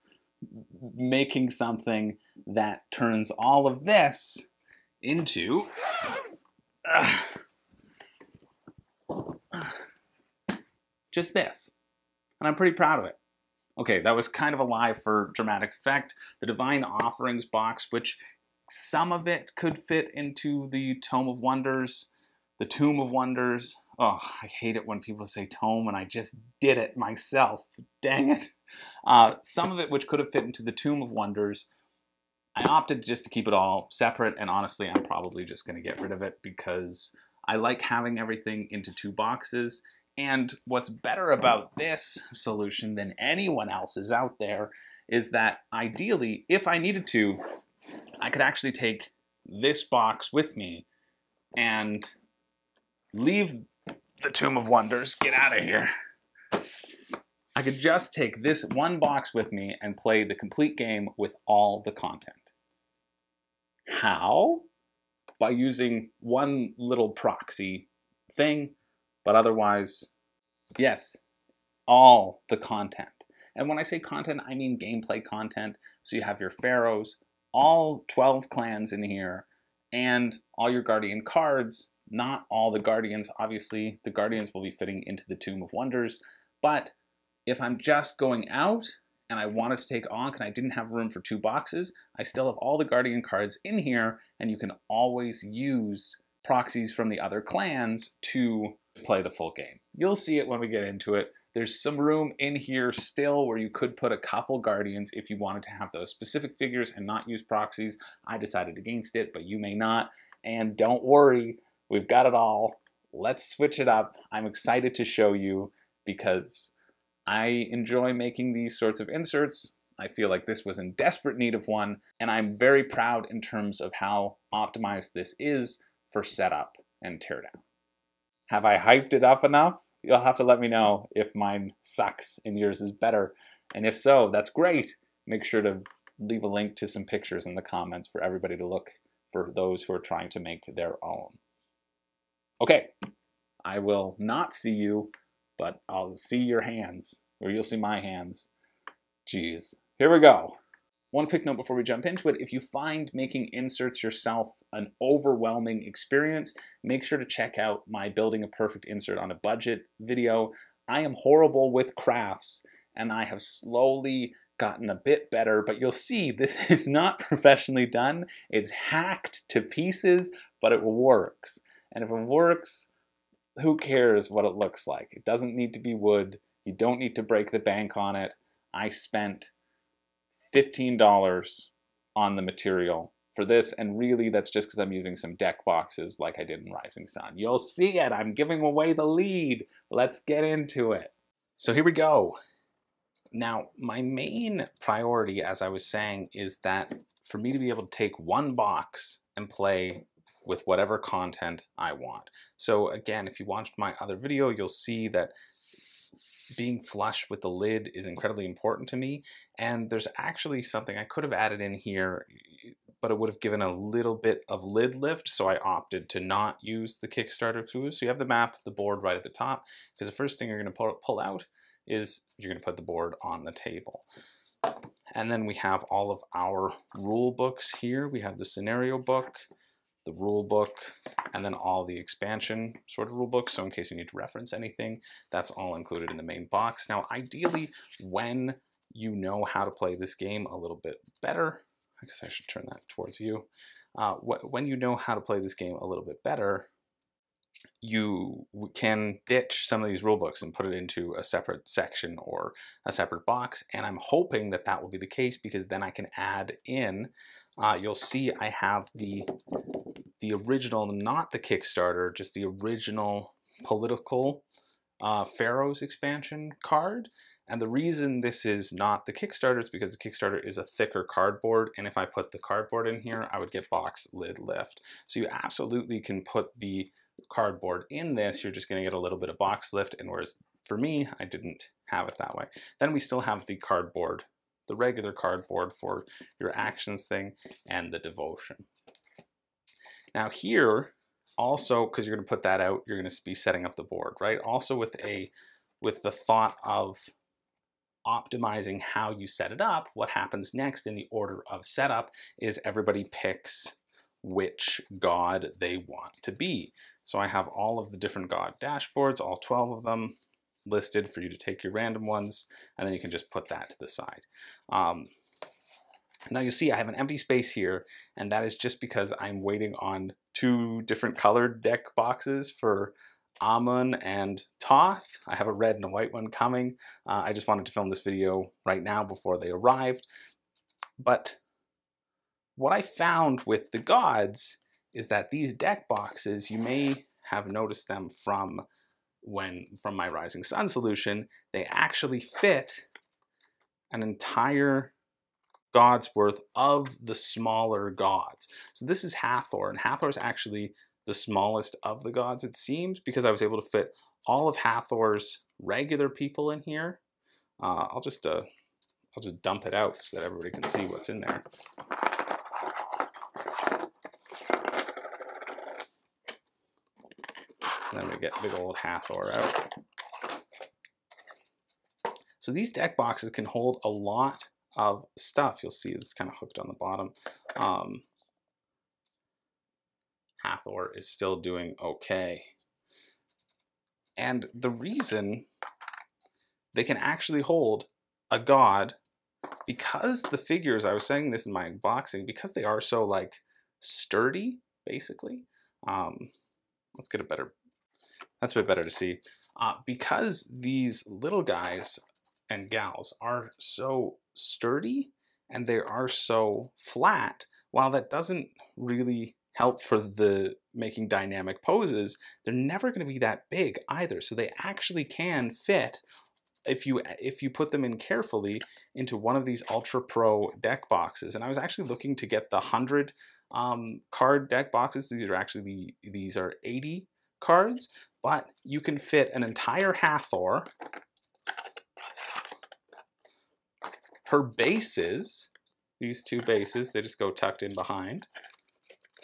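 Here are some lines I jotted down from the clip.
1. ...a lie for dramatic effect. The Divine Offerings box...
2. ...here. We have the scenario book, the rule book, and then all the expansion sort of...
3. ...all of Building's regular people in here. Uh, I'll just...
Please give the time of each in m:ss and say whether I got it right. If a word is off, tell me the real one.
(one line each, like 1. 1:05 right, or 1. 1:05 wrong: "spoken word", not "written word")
1. 0:14 right
2. 3:47 right
3. 5:54 wrong: "Hathor", not "Building".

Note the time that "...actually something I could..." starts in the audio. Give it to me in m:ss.
3:30.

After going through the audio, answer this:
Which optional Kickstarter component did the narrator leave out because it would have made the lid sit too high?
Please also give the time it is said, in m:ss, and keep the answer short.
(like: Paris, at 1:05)
Kickstarter clue, at 3:37.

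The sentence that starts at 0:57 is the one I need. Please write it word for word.
I could just take this one box with me and play the complete game with all the content.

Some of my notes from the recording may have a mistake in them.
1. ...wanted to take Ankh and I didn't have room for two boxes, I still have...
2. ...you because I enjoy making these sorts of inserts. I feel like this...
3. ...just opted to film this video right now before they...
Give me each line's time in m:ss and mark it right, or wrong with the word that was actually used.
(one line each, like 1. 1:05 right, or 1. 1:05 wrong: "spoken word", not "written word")
1. 1:29 right
2. 1:55 right
3. 5:27 wrong: "wanted", not "opted".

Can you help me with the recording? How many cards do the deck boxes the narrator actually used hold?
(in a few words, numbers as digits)
80.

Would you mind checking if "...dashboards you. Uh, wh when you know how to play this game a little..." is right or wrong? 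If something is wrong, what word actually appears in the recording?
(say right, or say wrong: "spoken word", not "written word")
wrong: "towards", not "dashboards".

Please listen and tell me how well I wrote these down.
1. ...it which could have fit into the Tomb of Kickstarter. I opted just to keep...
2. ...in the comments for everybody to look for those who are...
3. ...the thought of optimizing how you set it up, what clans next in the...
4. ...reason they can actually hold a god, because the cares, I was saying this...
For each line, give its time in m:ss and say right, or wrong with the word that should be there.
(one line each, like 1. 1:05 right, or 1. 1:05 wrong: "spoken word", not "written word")
1. 0:29 wrong: "Wonders", not "Kickstarter"
2. 2:17 right
3. 4:56 wrong: "happens", not "clans"
4. 6:24 wrong: "figures", not "cares".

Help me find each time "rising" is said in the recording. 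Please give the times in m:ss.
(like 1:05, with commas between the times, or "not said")
3:06, 5:40.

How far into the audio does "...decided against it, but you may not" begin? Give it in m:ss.
1:48.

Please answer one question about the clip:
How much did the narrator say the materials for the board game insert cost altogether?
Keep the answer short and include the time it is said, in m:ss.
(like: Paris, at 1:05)
$15, at 3:00.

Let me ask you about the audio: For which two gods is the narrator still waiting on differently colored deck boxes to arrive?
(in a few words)
Amun and Thoth.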